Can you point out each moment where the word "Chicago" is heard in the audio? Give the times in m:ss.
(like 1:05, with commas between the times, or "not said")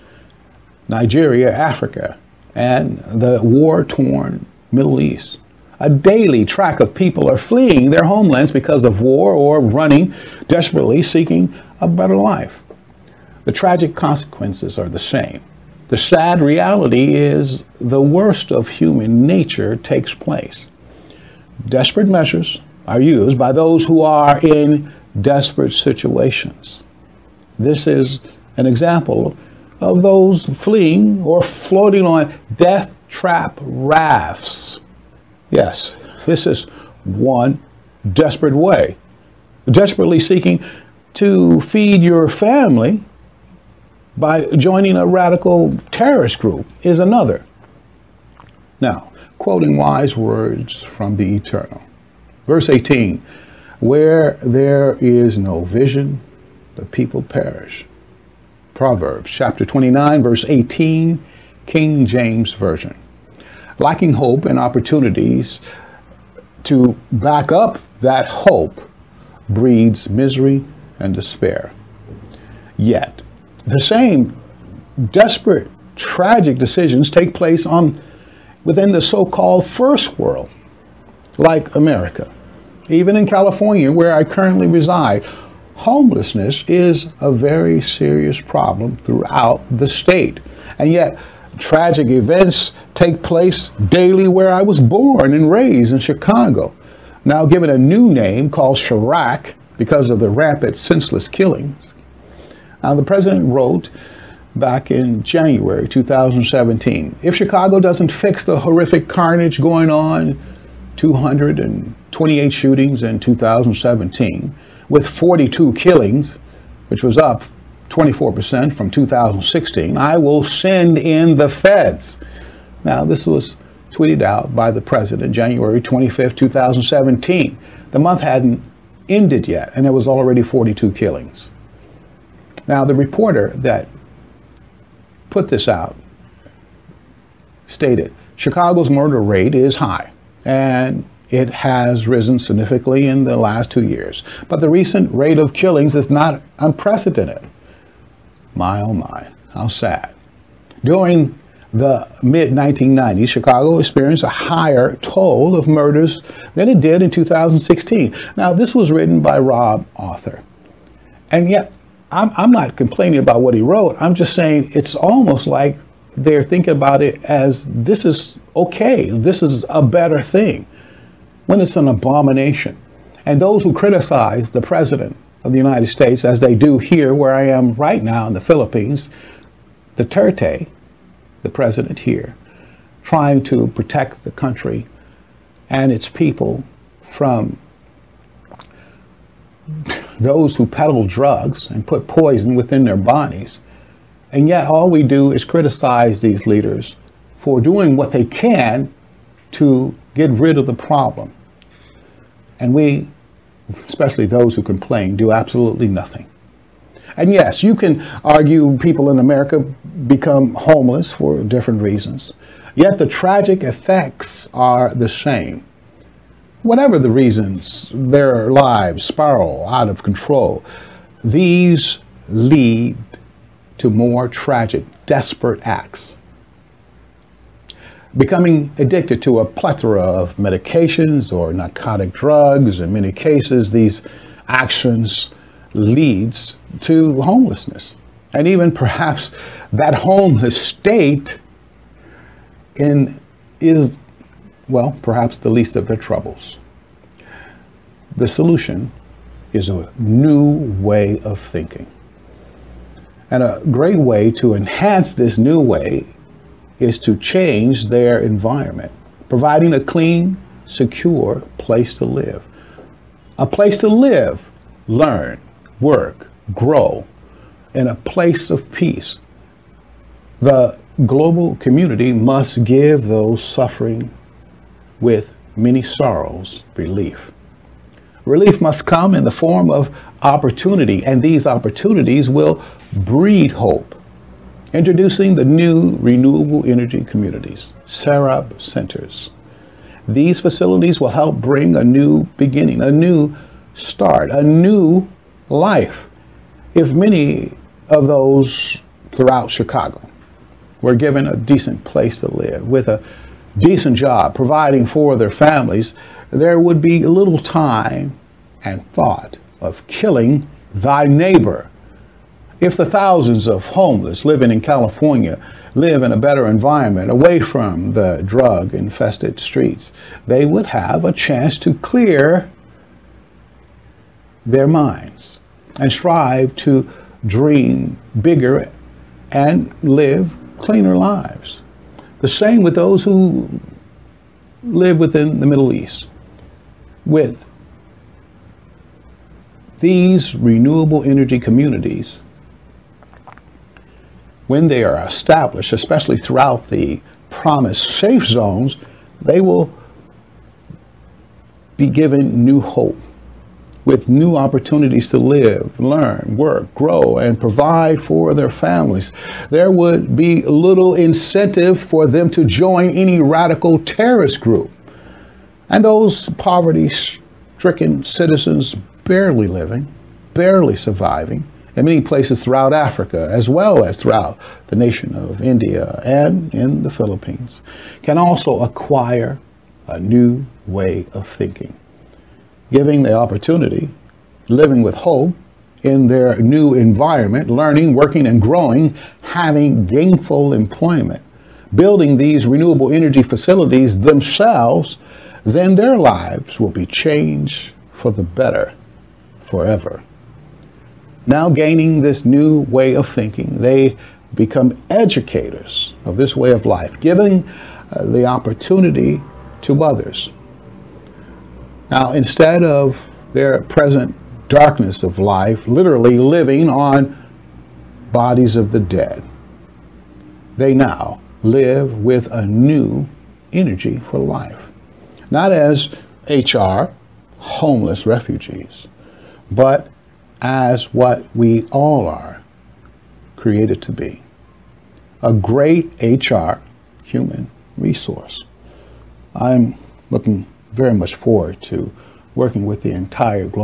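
1:35, 1:47, 2:18, 2:33, 4:59.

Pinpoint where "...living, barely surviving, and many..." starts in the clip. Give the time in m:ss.
6:09.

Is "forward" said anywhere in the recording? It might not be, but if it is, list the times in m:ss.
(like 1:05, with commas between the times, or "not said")
7:21.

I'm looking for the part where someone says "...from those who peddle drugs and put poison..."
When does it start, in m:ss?
3:07.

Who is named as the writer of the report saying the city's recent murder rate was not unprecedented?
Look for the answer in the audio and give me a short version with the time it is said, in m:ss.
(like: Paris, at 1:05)
Rob Arthur, at 2:39.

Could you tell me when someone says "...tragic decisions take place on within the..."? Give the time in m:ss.
1:15.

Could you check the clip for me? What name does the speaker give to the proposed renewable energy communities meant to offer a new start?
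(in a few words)
SARAP centers.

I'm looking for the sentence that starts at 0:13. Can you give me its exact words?
The tragic consequences are the same.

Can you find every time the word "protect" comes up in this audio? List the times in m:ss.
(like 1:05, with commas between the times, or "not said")
3:03.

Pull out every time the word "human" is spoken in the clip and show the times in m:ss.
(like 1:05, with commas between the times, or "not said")
0:18, 7:17.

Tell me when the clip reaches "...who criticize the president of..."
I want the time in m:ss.
2:53.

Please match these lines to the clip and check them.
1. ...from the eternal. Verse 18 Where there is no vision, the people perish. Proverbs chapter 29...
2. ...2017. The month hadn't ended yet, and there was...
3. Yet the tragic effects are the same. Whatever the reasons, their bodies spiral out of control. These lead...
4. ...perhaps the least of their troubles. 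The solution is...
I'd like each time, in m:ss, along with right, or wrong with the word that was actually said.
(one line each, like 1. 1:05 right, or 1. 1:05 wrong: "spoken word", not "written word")
1. 0:50 right
2. 2:06 right
3. 3:32 wrong: "lives", not "bodies"
4. 4:05 right.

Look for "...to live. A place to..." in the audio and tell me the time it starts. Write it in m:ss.
4:21.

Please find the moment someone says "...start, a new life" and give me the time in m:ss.
4:53.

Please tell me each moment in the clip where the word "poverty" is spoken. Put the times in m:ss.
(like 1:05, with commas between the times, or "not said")
6:06.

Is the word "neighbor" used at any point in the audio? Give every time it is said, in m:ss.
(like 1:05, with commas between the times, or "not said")
5:11.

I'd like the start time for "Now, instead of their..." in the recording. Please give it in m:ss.
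6:51.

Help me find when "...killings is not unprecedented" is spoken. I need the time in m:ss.
2:25.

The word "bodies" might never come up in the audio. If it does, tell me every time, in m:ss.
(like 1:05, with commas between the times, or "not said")
3:12, 6:58.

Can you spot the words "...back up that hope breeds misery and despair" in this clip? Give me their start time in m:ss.
1:07.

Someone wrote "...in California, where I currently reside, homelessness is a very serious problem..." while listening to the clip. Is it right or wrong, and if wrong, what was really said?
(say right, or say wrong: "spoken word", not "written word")
right.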